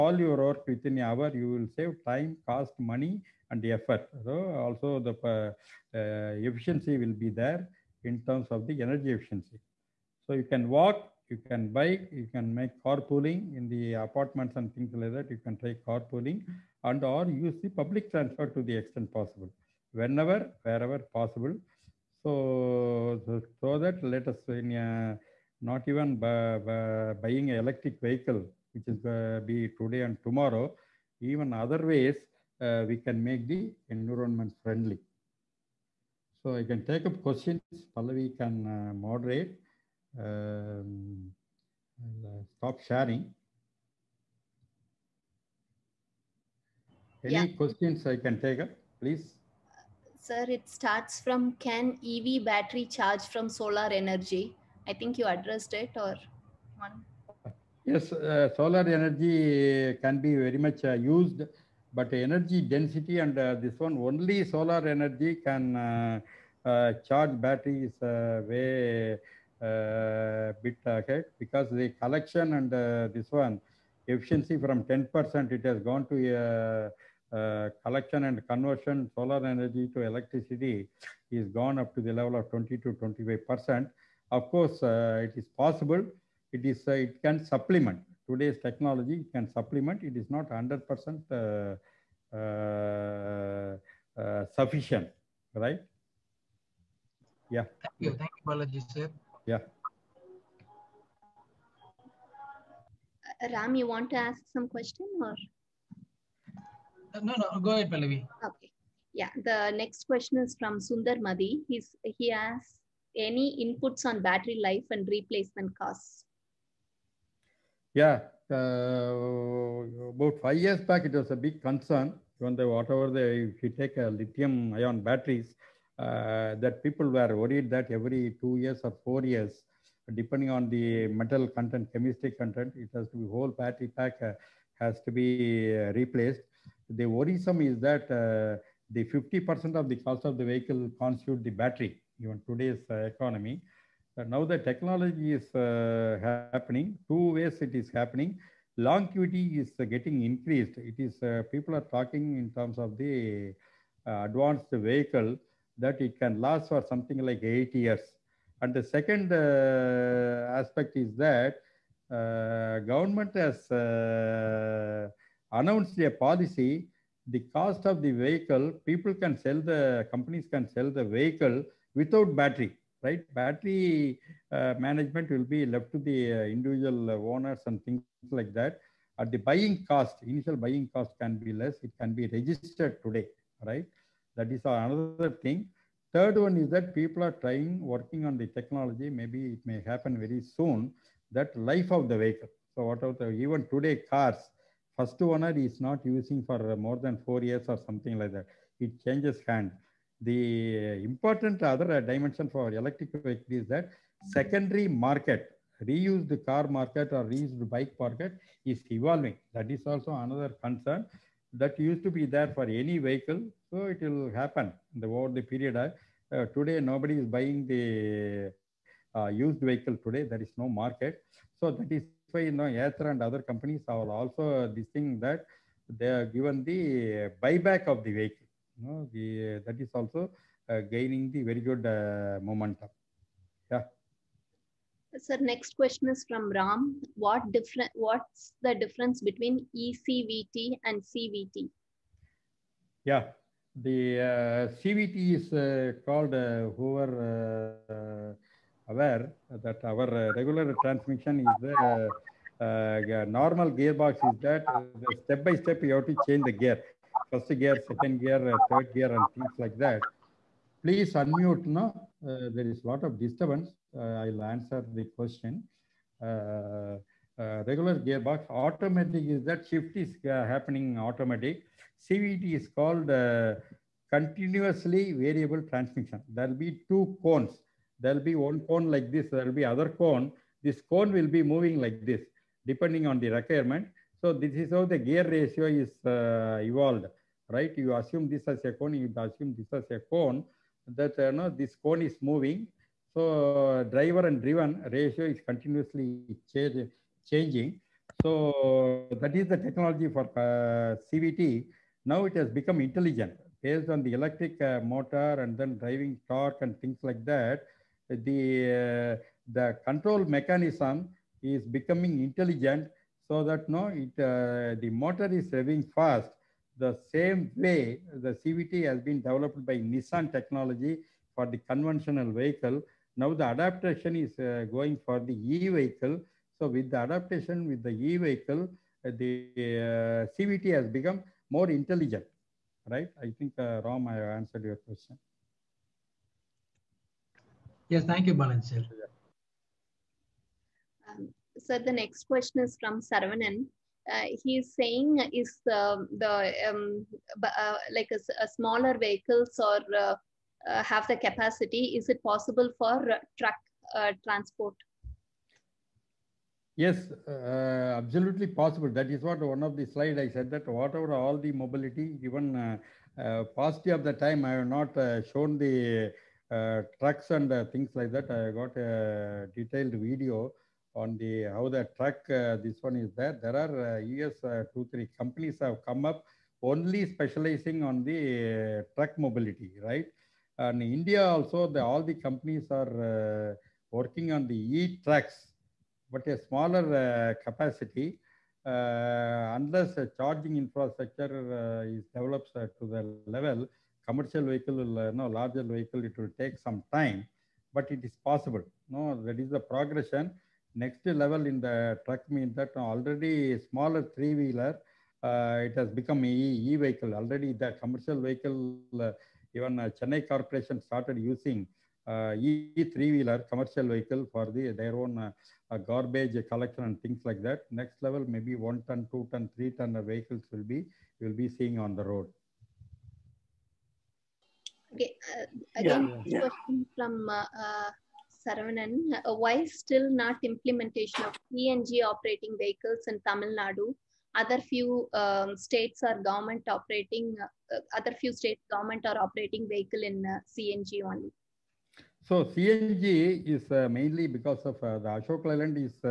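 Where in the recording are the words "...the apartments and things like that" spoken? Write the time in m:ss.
0:13.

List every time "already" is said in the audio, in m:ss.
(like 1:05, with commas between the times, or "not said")
6:42, 6:47.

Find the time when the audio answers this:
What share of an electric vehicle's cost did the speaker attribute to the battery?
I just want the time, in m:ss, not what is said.
2:19.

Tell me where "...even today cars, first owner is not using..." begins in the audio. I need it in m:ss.
3:13.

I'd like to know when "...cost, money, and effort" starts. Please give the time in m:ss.
0:02.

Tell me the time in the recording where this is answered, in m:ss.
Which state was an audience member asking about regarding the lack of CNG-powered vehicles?
7:13.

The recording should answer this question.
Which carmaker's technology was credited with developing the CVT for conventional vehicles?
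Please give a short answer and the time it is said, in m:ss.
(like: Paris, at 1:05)
Nissan, at 5:19.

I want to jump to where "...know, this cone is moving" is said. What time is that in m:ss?
4:51.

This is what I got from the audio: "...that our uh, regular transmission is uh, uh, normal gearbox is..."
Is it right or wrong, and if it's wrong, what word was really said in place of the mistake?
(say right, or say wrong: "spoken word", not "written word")
right.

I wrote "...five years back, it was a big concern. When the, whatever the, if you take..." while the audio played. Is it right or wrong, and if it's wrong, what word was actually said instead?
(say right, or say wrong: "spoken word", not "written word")
right.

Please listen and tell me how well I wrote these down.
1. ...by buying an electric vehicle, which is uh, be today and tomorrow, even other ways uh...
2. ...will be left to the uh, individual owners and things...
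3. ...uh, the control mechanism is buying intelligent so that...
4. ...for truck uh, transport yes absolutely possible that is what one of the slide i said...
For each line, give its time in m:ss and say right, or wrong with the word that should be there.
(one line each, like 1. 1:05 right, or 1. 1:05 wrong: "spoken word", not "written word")
1. 0:26 right
2. 2:55 right
3. 5:09 wrong: "becoming", not "buying"
4. 5:52 right.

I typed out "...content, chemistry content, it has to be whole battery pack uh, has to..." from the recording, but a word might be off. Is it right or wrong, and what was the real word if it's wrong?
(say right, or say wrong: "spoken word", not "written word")
right.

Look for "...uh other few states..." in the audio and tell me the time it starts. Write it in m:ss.
7:17.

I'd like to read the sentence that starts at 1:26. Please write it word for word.
It is uh, it can supplement today's technology can supplement.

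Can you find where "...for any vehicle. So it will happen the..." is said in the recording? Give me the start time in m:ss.
3:32.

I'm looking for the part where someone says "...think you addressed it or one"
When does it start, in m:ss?
0:54.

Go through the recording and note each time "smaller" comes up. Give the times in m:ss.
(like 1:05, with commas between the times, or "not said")
5:48, 6:26, 6:43.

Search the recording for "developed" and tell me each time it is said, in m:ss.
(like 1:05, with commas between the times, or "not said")
5:19, 6:32.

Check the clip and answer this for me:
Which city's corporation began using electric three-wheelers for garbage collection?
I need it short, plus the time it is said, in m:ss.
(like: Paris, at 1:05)
Chennai, at 6:49.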